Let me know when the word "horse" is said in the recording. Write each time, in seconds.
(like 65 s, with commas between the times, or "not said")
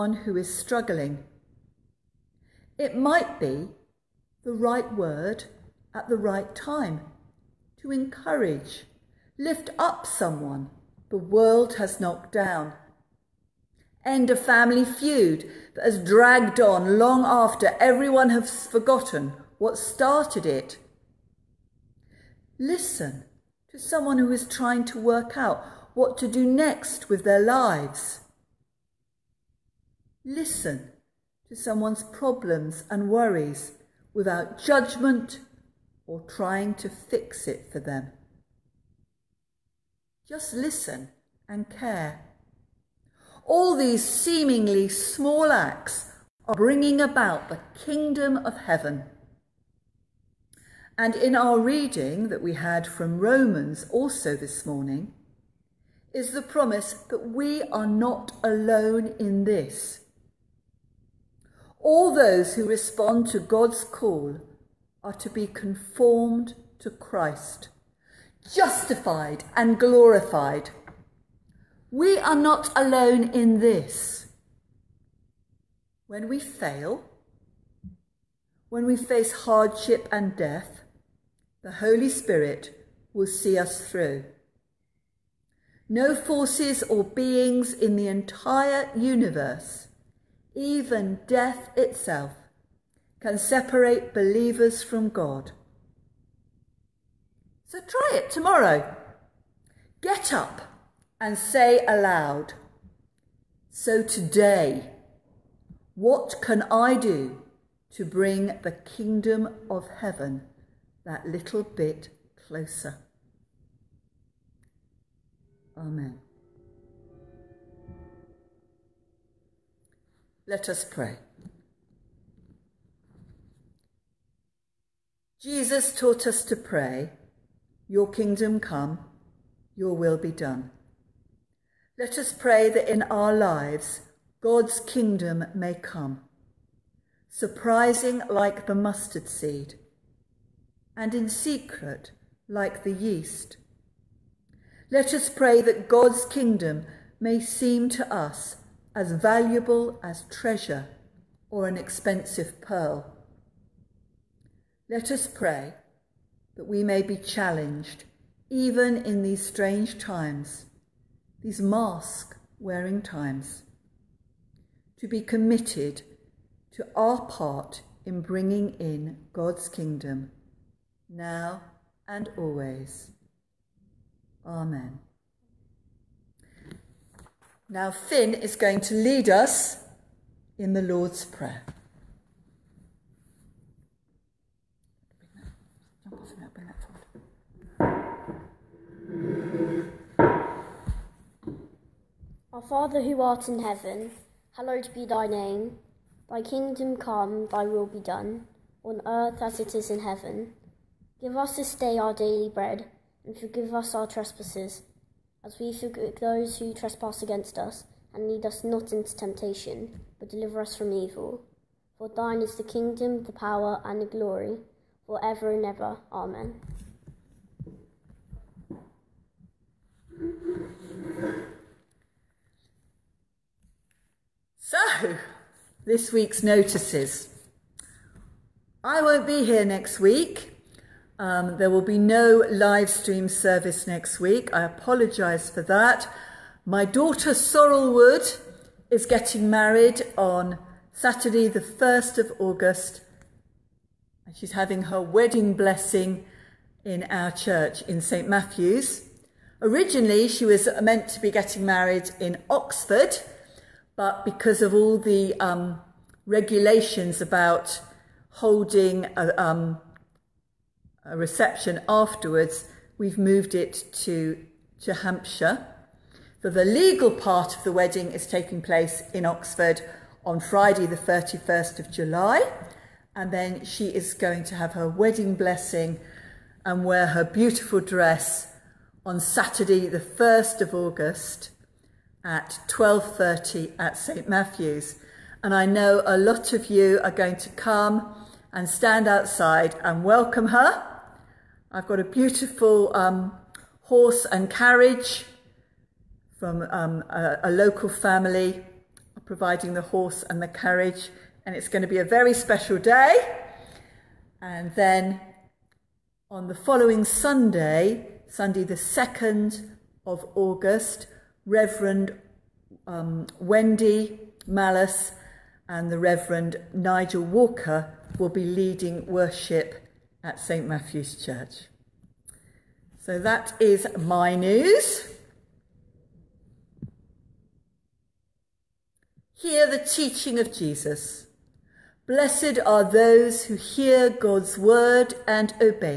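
293 s, 299 s.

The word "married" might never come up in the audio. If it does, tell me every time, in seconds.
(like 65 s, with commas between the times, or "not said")
239 s, 251 s.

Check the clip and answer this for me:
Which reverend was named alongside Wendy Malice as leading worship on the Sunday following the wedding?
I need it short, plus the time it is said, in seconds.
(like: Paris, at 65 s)
Nigel Walker, at 316 s.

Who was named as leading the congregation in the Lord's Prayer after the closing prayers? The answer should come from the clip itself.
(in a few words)
Finn.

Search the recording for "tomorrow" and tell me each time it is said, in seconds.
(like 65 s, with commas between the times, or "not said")
98 s.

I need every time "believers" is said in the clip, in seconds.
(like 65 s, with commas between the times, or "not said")
94 s.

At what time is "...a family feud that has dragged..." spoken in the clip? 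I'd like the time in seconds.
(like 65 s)
14 s.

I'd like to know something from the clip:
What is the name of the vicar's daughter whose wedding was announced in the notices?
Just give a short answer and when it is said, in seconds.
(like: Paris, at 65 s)
Sorrel Wood, at 237 s.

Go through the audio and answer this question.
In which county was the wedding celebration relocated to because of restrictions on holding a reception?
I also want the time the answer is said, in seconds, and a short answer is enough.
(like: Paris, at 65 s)
Hampshire, at 264 s.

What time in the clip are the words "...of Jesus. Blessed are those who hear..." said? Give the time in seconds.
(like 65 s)
330 s.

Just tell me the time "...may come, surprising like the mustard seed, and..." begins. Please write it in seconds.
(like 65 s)
135 s.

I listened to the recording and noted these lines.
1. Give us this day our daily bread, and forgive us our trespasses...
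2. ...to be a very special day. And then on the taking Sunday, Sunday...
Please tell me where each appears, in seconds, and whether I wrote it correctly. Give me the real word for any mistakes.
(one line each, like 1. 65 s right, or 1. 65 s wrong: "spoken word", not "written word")
1. 201 s right
2. 301 s wrong: "following", not "taking".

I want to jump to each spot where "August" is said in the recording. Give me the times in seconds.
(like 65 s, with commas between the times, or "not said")
242 s, 280 s, 310 s.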